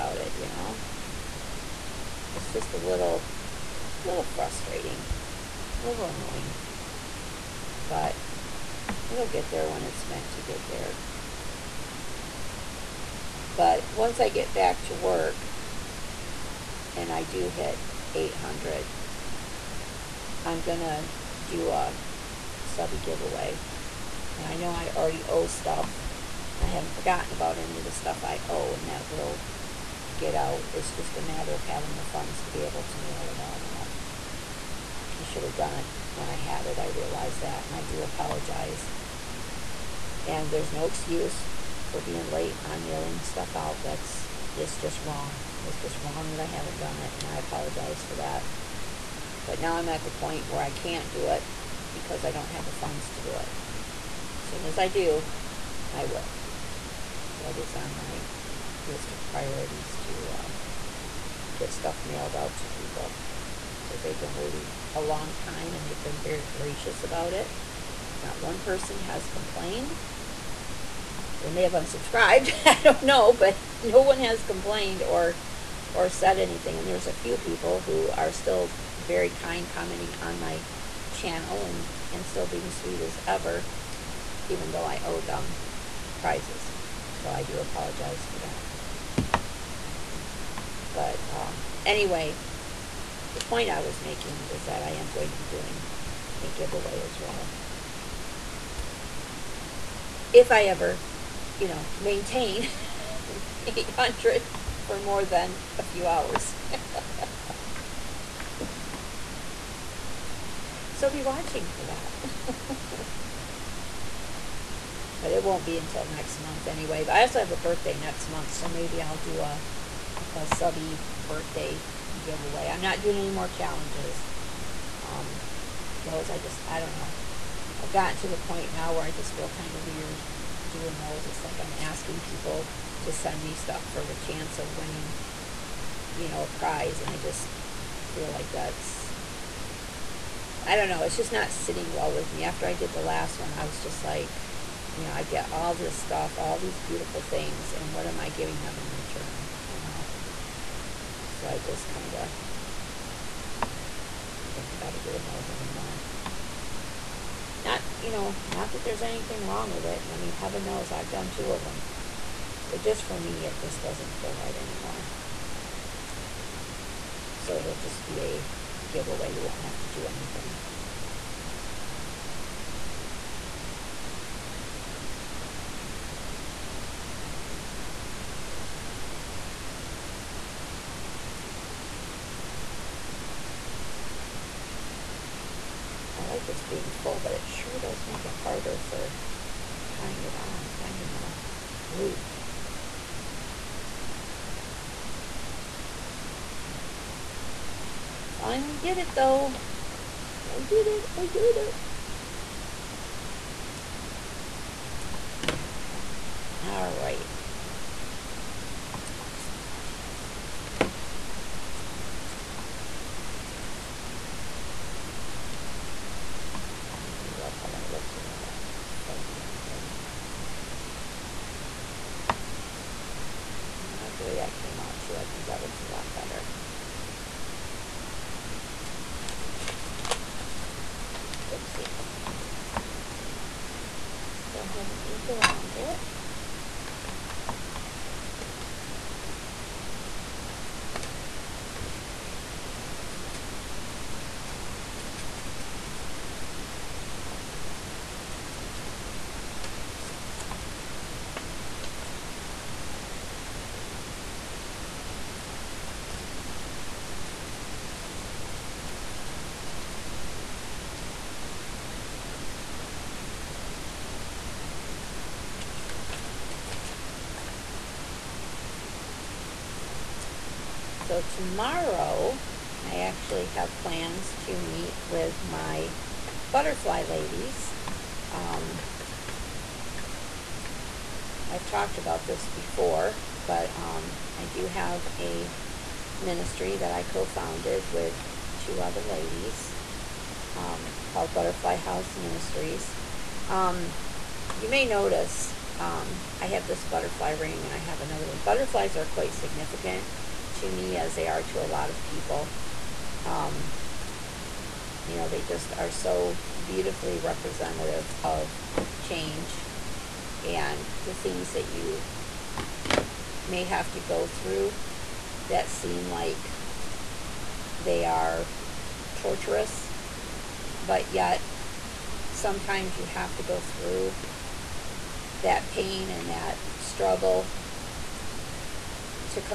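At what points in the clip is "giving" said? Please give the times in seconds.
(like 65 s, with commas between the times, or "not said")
148 s.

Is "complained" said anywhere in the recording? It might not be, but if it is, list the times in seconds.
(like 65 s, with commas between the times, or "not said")
69 s, 74 s.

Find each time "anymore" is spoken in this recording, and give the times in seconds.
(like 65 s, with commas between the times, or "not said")
155 s, 164 s.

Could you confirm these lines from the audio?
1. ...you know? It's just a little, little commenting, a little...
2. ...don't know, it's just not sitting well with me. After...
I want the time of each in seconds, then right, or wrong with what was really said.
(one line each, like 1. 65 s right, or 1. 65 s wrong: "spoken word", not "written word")
1. 0 s wrong: "frustrating", not "commenting"
2. 140 s right.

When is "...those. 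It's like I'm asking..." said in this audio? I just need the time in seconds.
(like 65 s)
130 s.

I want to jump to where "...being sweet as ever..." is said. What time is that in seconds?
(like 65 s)
82 s.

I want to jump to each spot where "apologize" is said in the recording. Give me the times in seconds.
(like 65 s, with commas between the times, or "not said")
38 s, 47 s, 87 s.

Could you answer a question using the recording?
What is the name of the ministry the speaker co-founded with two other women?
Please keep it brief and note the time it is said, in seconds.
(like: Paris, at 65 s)
Butterfly House Ministries, at 291 s.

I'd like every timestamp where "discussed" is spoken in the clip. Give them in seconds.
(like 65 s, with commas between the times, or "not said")
not said.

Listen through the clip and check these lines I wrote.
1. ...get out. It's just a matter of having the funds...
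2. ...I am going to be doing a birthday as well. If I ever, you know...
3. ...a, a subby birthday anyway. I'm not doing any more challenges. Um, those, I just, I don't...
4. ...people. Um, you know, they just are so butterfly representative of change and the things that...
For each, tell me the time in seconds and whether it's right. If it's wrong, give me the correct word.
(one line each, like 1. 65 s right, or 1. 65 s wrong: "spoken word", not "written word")
1. 30 s right
2. 94 s wrong: "giveaway", not "birthday"
3. 119 s wrong: "giveaway", not "anyway"
4. 302 s wrong: "beautifully", not "butterfly".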